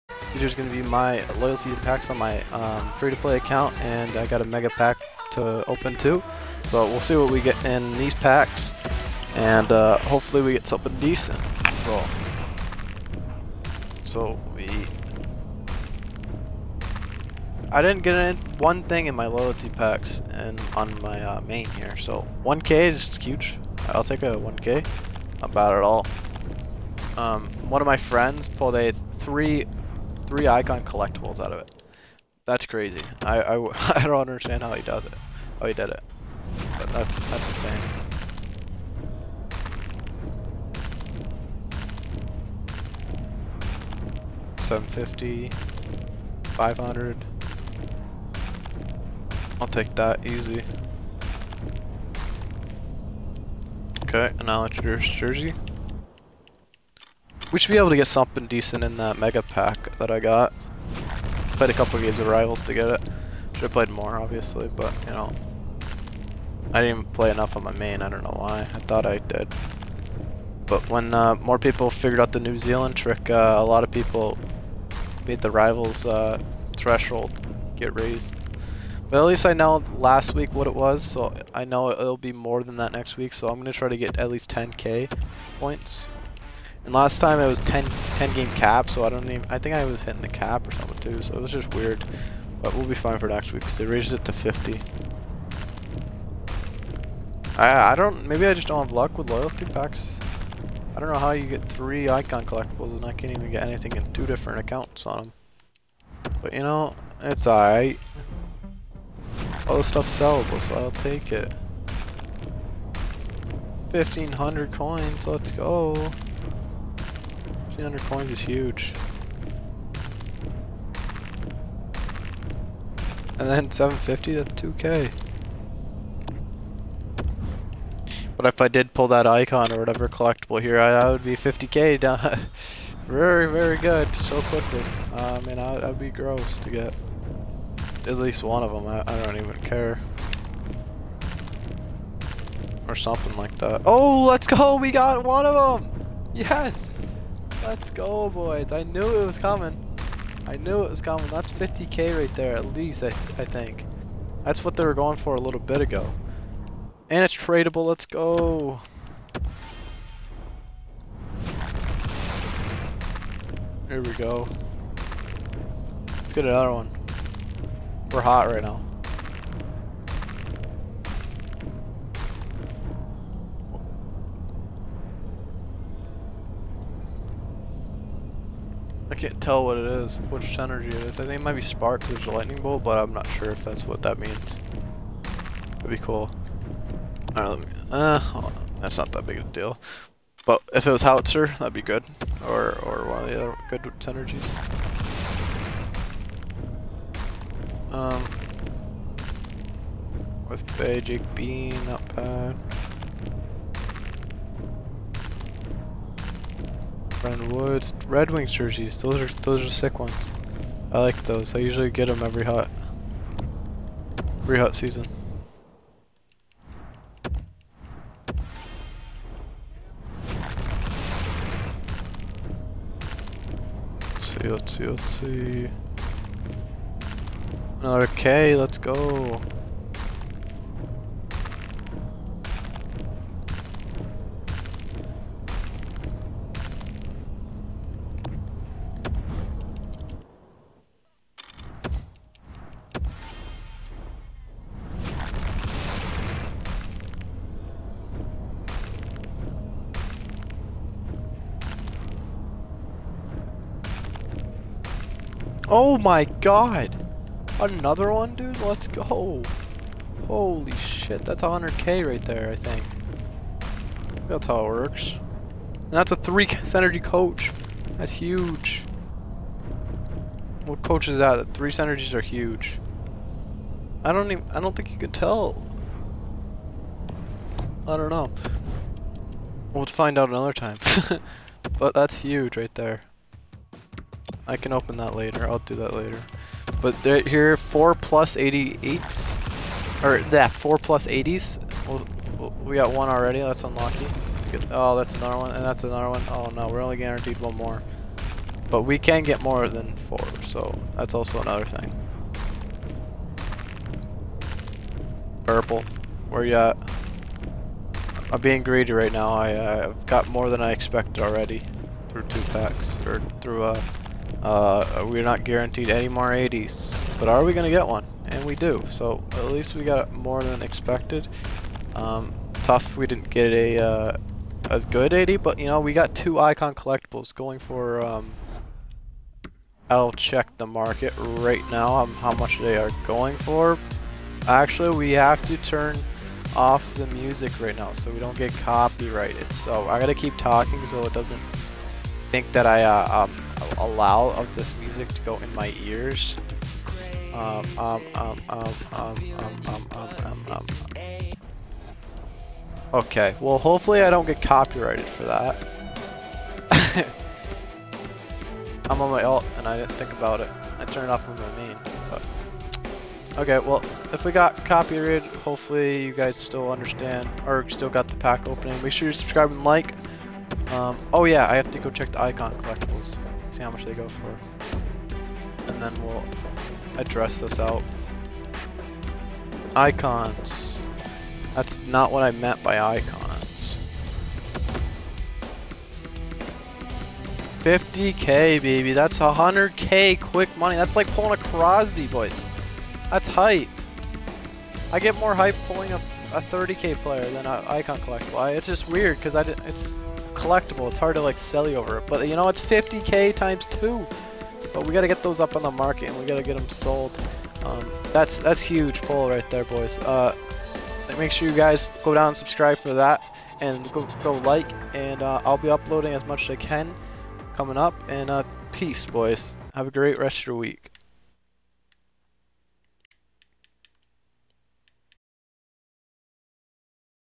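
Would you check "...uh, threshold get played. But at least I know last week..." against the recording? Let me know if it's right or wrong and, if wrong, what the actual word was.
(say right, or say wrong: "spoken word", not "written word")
wrong: "raised", not "played".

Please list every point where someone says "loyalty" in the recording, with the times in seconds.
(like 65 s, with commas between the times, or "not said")
1 s, 19 s, 99 s.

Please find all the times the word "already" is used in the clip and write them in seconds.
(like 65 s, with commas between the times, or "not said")
293 s, 311 s.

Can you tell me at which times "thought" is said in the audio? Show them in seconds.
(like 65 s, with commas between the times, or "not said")
68 s.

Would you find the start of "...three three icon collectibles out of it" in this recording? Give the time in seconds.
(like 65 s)
29 s.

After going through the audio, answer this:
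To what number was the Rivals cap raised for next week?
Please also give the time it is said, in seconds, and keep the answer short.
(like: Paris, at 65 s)
50, at 94 s.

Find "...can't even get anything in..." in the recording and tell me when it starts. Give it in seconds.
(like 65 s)
103 s.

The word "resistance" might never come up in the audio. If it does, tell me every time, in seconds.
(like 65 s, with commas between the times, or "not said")
not said.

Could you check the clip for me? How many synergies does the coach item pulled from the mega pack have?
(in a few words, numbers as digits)
3.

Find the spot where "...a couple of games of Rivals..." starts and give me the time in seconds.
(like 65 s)
61 s.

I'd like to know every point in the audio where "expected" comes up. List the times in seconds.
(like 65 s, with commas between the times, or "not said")
310 s, 320 s.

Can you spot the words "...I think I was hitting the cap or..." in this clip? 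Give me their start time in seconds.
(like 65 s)
89 s.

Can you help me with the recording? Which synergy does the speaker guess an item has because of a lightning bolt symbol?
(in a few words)
spark.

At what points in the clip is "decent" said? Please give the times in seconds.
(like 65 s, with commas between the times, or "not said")
10 s, 58 s.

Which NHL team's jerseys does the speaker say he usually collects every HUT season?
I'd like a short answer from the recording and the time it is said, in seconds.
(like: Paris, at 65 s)
Red Wings, at 208 s.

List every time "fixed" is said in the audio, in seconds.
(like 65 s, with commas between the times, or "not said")
not said.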